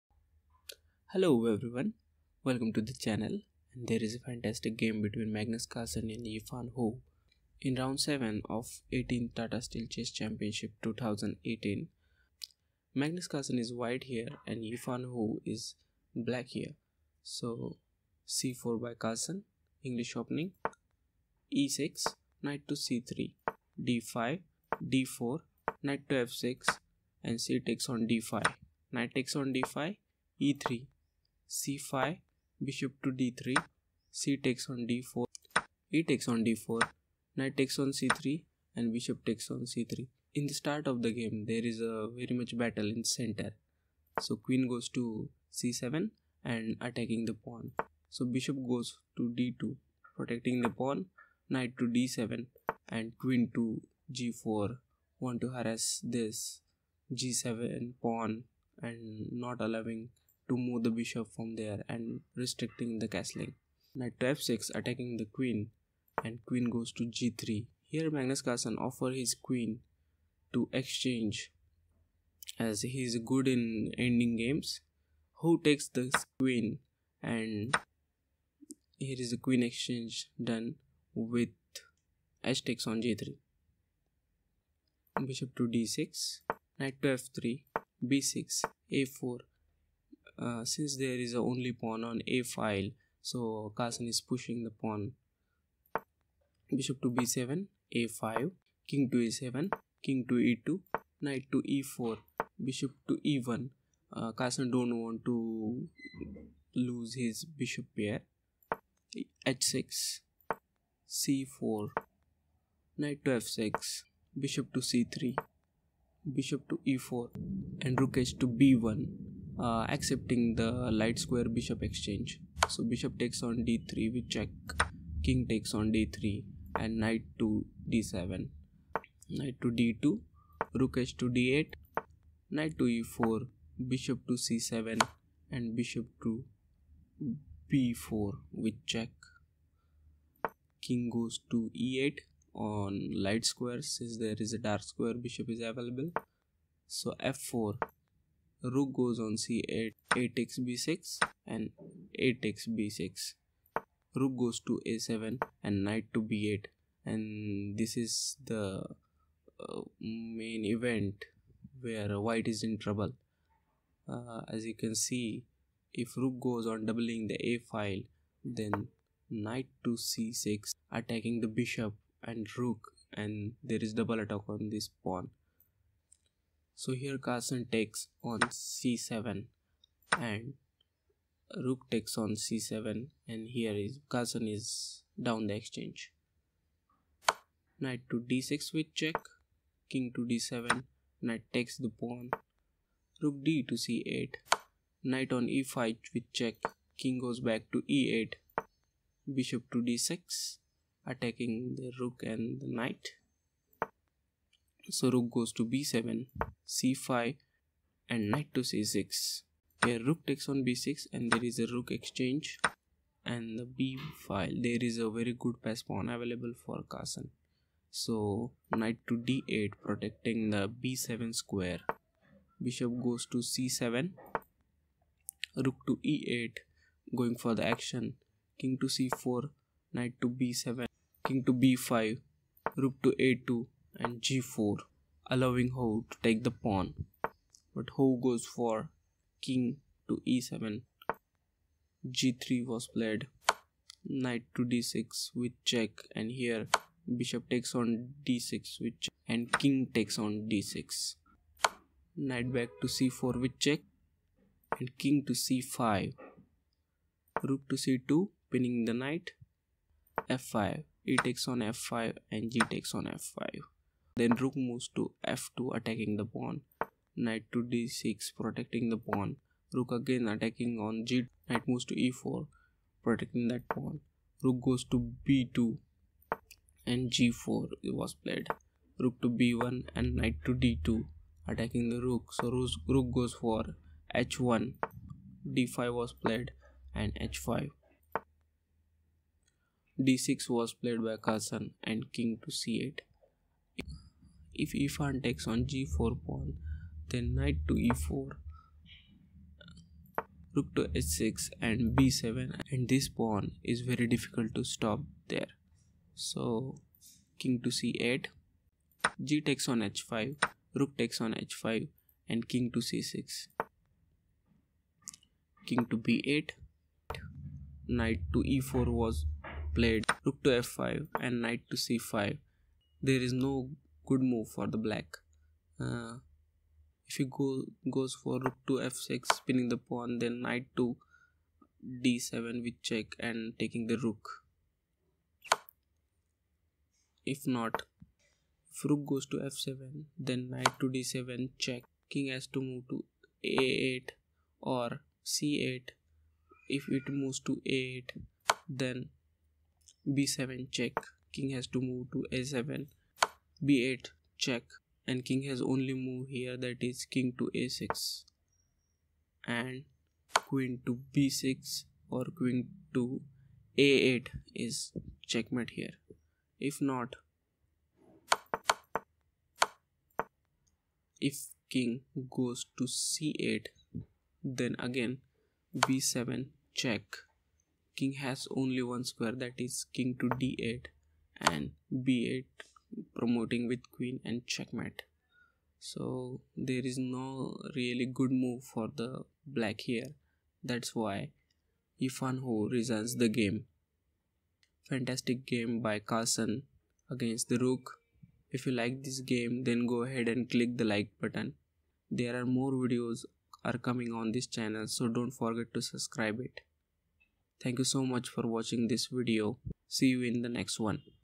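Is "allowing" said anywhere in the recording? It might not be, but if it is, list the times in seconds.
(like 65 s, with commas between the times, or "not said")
59 s, 235 s.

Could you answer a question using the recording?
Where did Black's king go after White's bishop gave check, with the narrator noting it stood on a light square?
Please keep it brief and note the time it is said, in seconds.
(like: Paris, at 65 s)
e8, at 140 s.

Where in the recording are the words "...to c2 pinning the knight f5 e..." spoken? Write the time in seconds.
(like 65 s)
257 s.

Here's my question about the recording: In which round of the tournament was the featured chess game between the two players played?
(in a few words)
7.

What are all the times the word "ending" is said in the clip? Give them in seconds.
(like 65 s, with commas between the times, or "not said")
73 s.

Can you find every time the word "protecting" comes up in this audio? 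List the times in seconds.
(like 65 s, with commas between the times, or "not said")
50 s, 219 s, 268 s, 273 s.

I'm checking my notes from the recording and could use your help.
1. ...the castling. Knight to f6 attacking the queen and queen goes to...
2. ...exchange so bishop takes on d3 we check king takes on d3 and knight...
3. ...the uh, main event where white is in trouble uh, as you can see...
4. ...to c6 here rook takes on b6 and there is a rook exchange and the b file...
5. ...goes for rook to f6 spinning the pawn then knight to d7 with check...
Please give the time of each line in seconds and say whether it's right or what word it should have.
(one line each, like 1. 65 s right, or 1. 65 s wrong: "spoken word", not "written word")
1. 62 s right
2. 121 s right
3. 158 s right
4. 208 s right
5. 327 s right.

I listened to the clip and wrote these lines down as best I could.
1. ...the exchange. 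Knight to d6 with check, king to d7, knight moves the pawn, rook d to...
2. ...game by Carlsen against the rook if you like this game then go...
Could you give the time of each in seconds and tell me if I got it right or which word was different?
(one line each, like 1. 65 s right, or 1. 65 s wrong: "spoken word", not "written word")
1. 185 s wrong: "takes", not "moves"
2. 395 s right.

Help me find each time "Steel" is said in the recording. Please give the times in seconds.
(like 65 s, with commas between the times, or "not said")
9 s.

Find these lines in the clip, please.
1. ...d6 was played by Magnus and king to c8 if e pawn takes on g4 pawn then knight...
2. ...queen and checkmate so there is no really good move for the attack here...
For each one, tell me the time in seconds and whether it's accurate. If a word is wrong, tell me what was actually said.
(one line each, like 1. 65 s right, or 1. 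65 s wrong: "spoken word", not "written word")
1. 289 s wrong: "Carlsen", not "Magnus"
2. 383 s wrong: "black", not "attack".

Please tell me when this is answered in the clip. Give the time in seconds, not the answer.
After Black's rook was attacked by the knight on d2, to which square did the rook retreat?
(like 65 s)
282 s.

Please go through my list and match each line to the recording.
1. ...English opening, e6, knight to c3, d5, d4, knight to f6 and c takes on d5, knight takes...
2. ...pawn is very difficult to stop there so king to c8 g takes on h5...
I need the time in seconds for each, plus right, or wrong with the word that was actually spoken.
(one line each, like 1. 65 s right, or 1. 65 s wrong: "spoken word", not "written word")
1. 19 s right
2. 303 s right.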